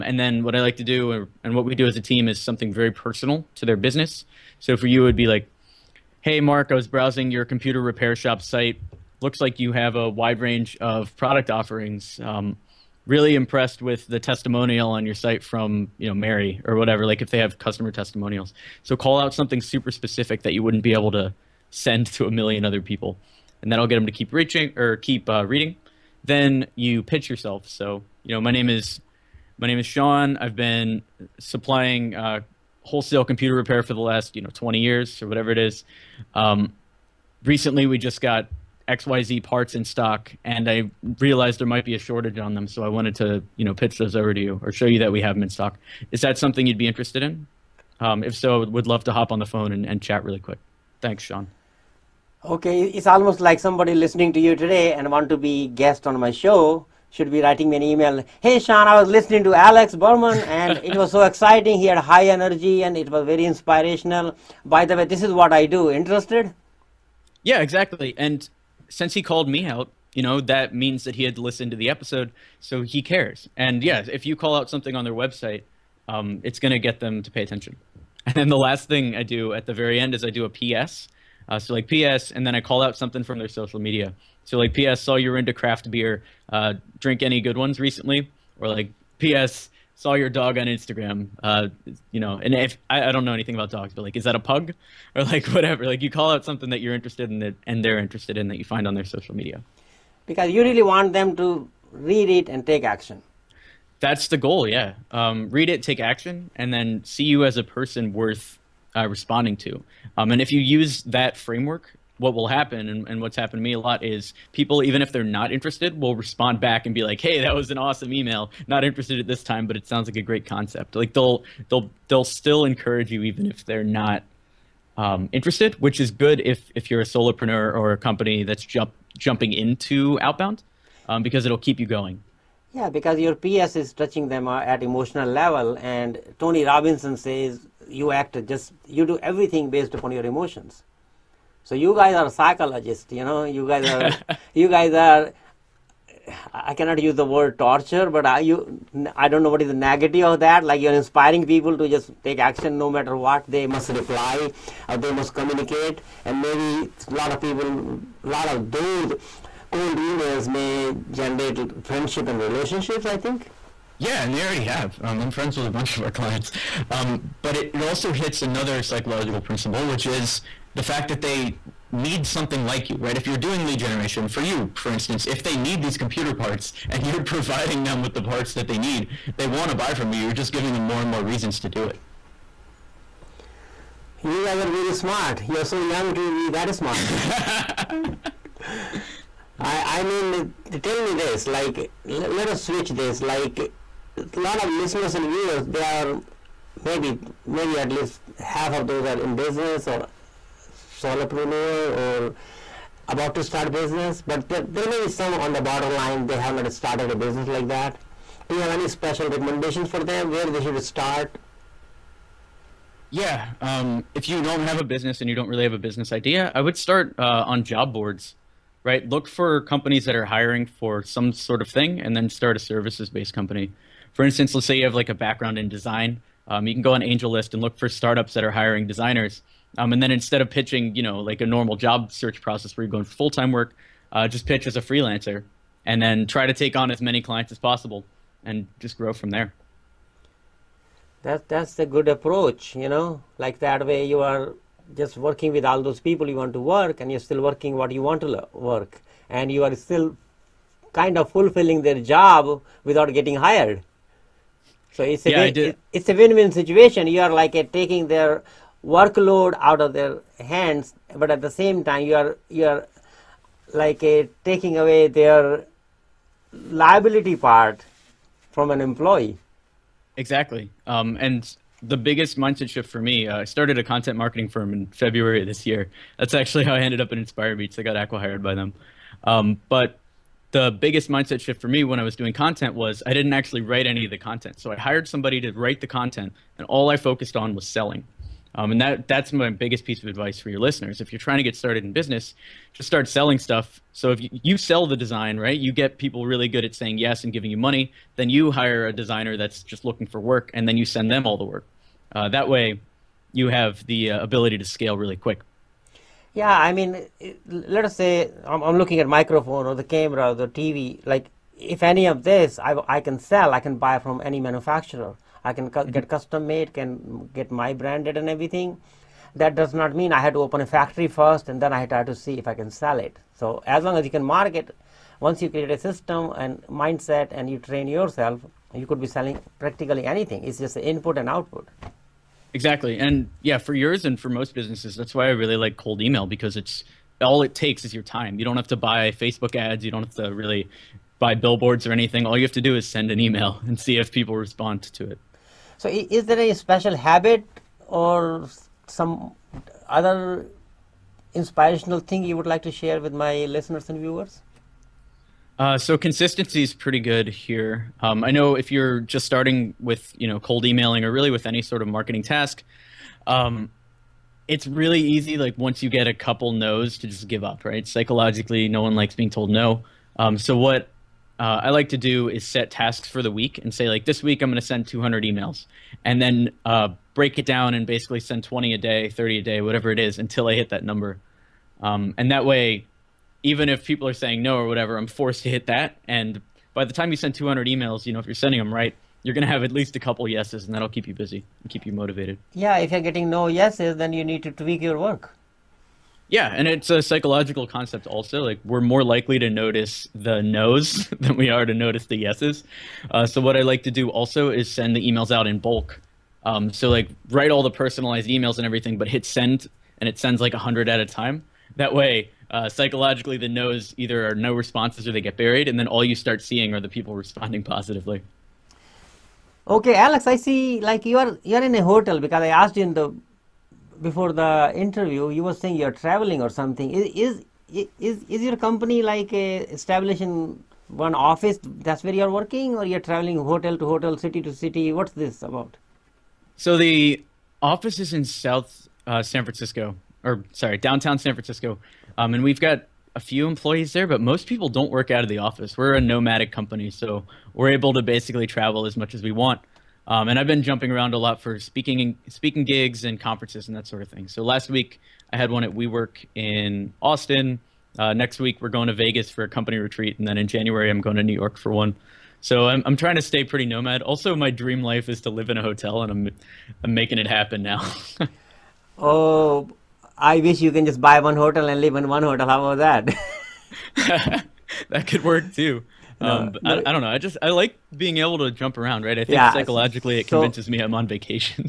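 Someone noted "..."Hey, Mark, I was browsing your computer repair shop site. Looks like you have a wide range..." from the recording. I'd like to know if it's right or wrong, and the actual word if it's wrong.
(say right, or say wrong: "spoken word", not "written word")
right.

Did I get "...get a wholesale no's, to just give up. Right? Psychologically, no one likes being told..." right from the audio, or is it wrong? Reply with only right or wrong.
wrong.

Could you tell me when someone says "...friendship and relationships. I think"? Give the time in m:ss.
2:41.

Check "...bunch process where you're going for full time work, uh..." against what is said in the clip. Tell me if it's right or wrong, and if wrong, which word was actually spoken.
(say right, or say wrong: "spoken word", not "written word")
wrong: "search", not "bunch".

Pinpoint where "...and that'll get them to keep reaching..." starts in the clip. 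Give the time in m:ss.
0:23.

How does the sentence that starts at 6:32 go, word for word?
Yeah, if you're getting no yeses, then you need to tweak your work.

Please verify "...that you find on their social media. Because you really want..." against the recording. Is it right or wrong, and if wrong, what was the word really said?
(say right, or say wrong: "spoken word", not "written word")
right.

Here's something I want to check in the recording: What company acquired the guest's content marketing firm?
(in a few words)
Inspire Beats.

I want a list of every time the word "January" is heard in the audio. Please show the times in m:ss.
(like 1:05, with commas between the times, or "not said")
7:40.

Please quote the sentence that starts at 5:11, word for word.
Like, if any of this I, I can sell, I can buy from any manufacturer.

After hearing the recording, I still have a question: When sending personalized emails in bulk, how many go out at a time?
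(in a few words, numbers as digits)
100.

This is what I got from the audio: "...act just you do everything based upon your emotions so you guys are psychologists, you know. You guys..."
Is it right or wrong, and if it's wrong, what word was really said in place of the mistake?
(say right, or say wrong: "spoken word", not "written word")
right.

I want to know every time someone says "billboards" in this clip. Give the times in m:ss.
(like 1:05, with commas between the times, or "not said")
5:41.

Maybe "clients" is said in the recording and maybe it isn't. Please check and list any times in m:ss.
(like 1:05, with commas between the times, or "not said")
2:46, 3:57.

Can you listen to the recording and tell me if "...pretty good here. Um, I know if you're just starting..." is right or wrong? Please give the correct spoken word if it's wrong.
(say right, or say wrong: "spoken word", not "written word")
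right.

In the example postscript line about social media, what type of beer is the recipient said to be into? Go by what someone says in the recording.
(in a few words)
craft beer.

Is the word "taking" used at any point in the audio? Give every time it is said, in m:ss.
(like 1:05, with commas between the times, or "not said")
4:17, 4:24.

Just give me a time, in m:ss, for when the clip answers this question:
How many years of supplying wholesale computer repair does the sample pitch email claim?
0:34.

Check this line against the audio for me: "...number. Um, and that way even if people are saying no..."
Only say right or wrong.
right.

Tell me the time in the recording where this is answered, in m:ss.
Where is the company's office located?
7:20.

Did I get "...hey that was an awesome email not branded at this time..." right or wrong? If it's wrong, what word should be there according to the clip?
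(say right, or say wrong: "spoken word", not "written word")
wrong: "interested", not "branded".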